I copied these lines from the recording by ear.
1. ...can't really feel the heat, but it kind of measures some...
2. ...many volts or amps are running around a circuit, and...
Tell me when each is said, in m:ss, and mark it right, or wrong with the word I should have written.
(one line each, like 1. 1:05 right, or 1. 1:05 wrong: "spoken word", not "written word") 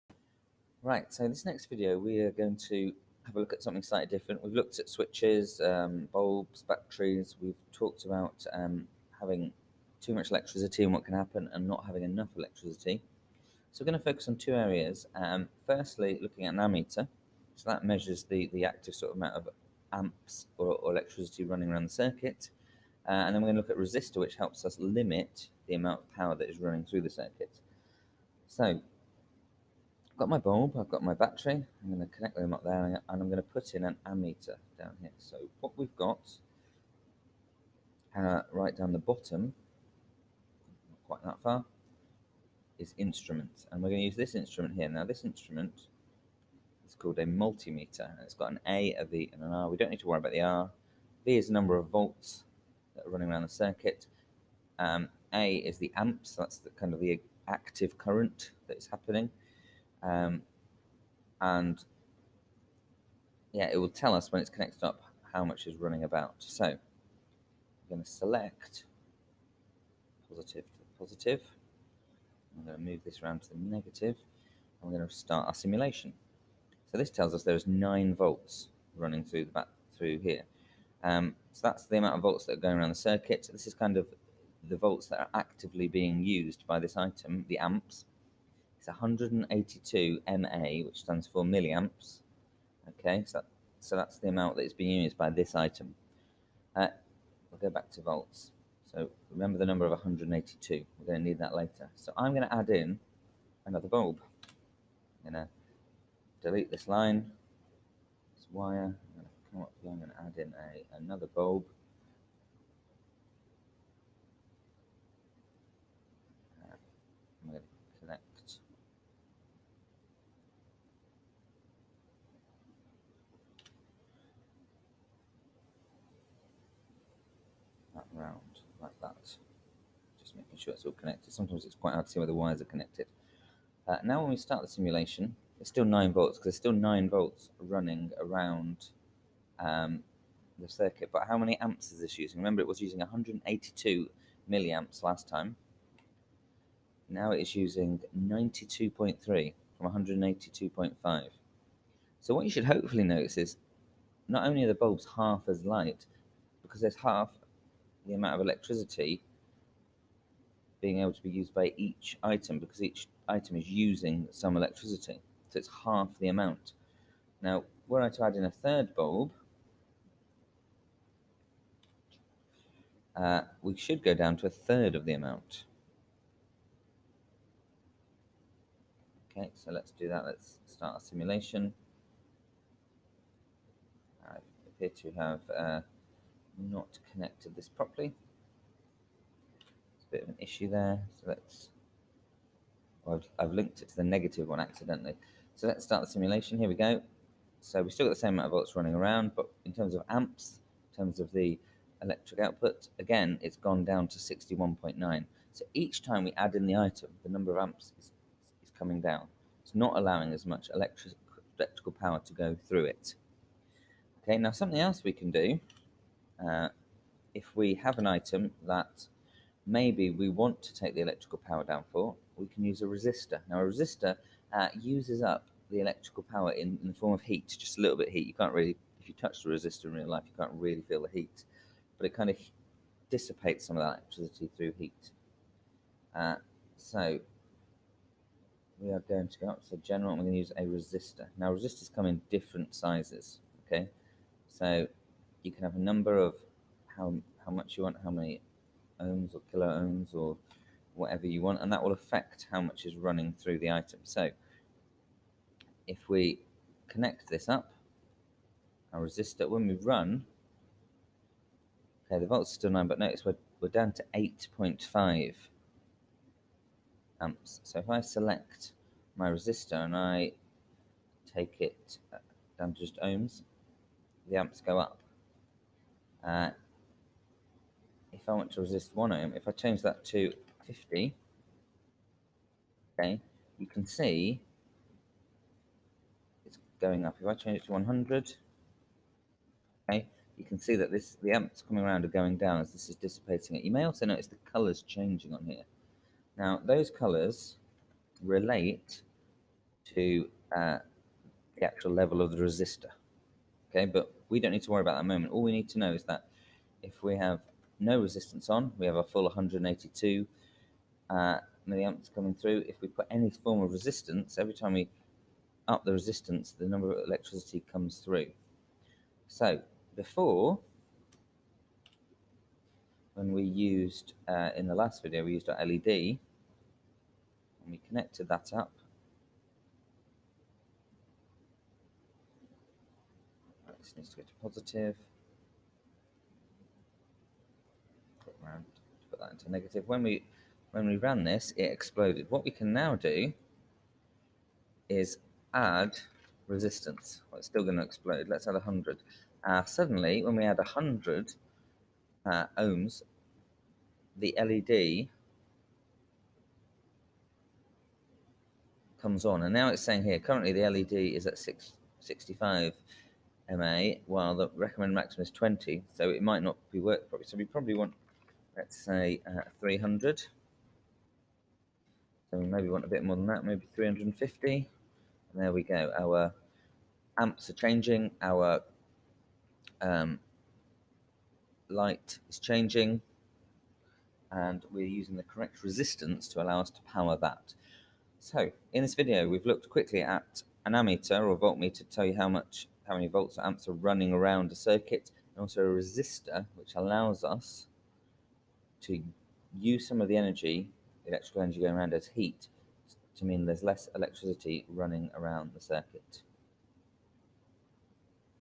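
1. 3:50 wrong: "dissipates", not "measures"
2. 6:32 right.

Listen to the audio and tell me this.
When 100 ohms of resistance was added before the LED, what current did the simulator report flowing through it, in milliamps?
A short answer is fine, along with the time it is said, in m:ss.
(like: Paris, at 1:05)
65, at 6:01.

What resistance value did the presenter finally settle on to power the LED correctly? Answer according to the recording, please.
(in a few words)
350.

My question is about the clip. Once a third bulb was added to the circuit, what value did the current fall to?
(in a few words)
61.9.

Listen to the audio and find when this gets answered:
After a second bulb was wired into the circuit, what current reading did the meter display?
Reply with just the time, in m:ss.
2:28.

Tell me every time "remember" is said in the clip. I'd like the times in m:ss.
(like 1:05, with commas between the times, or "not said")
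1:39, 2:22.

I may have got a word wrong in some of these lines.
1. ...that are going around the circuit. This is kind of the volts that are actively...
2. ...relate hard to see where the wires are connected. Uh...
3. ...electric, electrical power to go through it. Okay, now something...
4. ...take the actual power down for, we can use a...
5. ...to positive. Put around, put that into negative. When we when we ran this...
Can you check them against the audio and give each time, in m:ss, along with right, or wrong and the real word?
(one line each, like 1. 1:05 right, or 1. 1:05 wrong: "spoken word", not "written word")
1. 1:22 right
2. 2:11 wrong: "quite", not "relate"
3. 3:30 right
4. 3:40 wrong: "electrical", not "actual"
5. 5:34 right.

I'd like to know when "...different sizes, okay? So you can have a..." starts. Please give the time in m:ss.
4:02.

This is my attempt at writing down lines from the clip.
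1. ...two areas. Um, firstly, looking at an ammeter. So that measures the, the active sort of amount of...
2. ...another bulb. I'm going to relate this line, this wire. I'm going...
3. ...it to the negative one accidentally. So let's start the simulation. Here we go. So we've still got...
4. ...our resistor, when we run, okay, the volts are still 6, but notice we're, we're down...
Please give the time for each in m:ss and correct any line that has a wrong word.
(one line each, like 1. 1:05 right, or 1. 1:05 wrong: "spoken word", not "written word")
1. 0:14 right
2. 1:43 wrong: "delete", not "relate"
3. 3:13 right
4. 4:18 wrong: "9", not "6".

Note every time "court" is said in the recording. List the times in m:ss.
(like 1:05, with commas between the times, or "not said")
not said.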